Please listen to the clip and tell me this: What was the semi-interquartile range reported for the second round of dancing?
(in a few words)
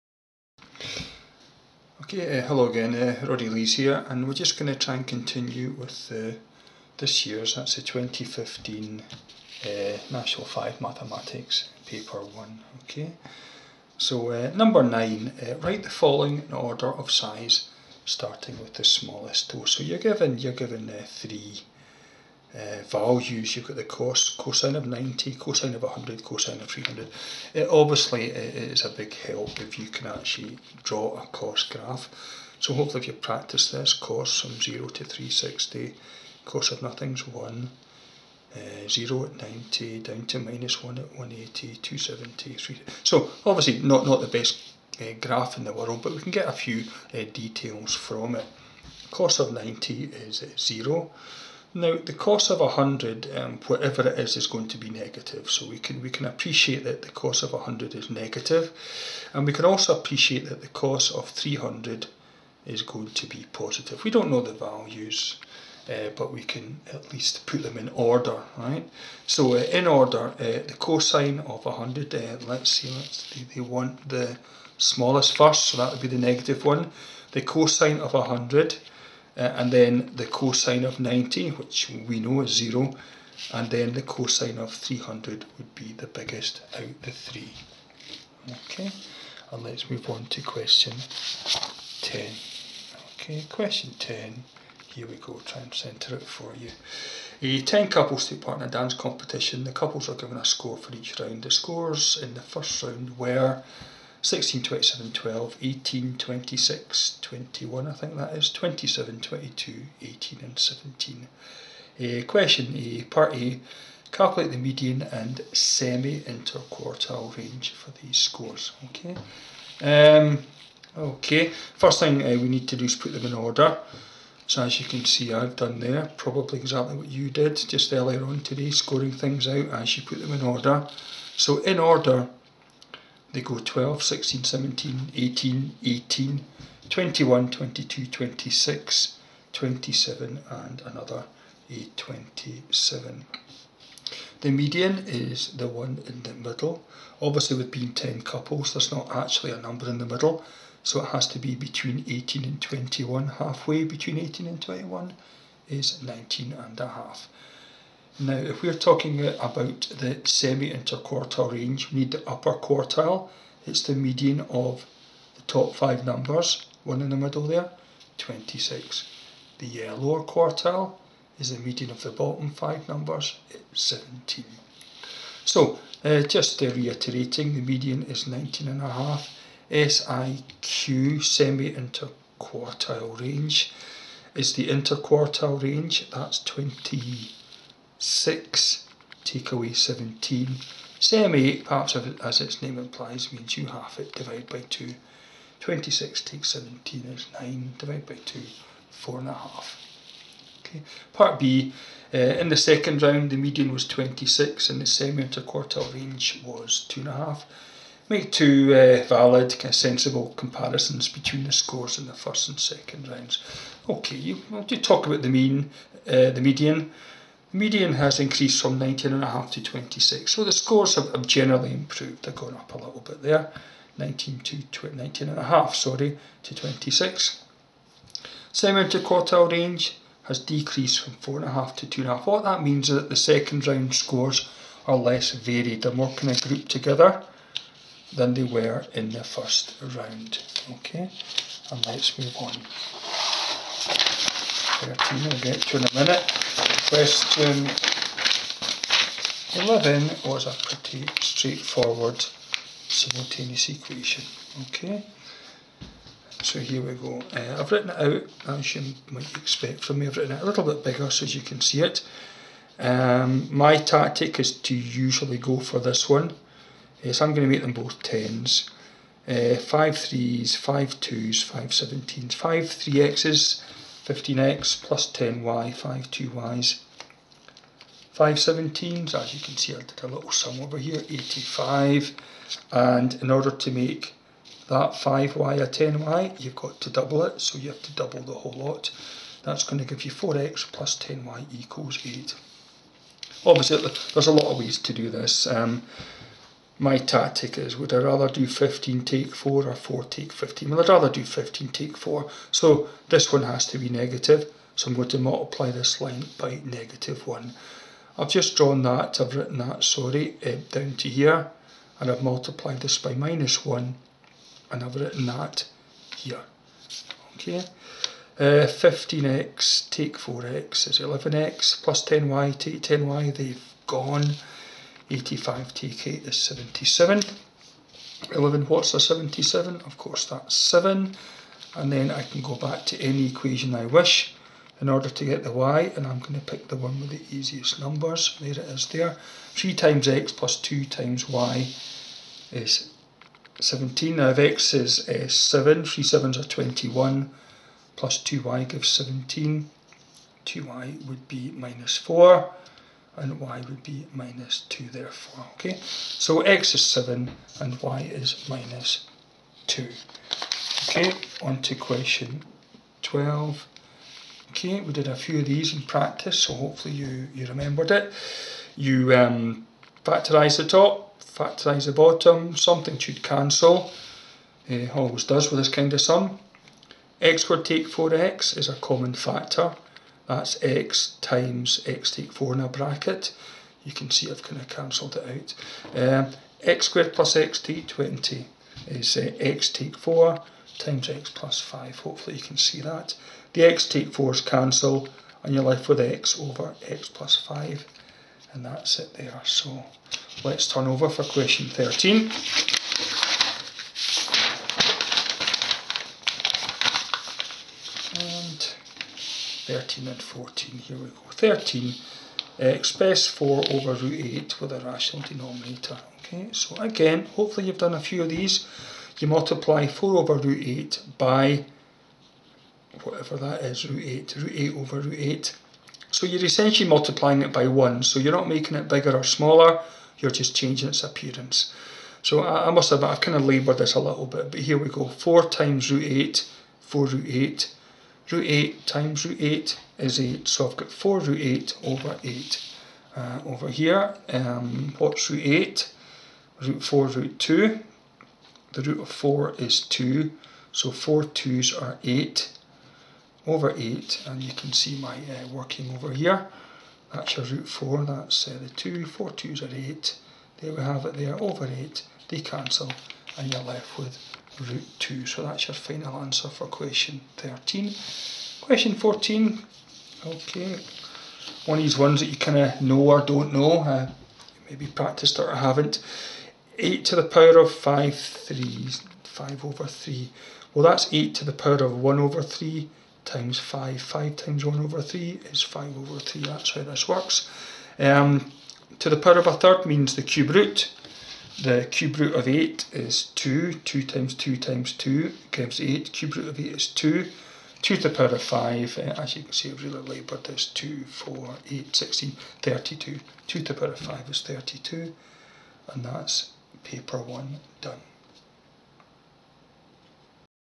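2.5.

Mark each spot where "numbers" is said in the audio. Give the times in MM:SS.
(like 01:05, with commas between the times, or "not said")
00:14, 02:29, 02:46, 02:52, 05:37.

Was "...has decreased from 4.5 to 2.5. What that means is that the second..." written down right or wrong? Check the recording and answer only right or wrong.
right.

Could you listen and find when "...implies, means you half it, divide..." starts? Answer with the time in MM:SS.
03:12.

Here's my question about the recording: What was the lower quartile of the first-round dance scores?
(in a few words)
17.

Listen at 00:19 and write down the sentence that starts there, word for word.
So you're given, you're given three uh, values.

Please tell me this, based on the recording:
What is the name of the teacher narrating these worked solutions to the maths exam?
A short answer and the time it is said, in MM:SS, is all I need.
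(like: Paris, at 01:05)
Roddy Lees, at 00:03.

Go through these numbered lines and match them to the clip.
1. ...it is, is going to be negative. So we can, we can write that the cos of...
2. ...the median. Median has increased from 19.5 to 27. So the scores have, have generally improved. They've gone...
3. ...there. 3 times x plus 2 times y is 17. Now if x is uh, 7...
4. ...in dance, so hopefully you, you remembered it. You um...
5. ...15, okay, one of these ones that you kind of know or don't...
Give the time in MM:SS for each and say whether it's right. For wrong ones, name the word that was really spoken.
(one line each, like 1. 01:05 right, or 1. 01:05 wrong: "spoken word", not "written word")
1. 00:54 wrong: "appreciate", not "write"
2. 03:36 wrong: "26", not "27"
3. 05:38 right
4. 06:05 wrong: "practice", not "dance"
5. 07:48 wrong: "14", not "15".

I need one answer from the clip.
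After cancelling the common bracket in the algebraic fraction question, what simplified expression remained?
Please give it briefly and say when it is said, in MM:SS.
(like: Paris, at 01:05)
x over x plus 5, at 06:35.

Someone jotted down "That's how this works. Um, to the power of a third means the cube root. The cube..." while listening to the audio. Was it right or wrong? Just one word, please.
right.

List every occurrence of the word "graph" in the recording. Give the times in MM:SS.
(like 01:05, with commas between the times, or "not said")
00:31, 00:45.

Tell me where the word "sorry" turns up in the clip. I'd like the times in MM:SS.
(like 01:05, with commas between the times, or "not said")
03:45, 05:09.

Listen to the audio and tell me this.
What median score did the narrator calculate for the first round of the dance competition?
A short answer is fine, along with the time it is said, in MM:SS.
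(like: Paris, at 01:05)
19.5, at 02:33.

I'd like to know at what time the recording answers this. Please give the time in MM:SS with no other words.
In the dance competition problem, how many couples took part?
01:37.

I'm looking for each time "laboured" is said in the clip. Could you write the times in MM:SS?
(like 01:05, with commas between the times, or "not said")
07:13, 08:20.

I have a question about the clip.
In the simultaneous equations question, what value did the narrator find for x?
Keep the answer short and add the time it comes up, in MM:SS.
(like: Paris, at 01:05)
7, at 05:29.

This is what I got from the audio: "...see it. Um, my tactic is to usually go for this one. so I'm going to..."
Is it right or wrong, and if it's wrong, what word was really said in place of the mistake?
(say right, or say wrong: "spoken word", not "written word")
right.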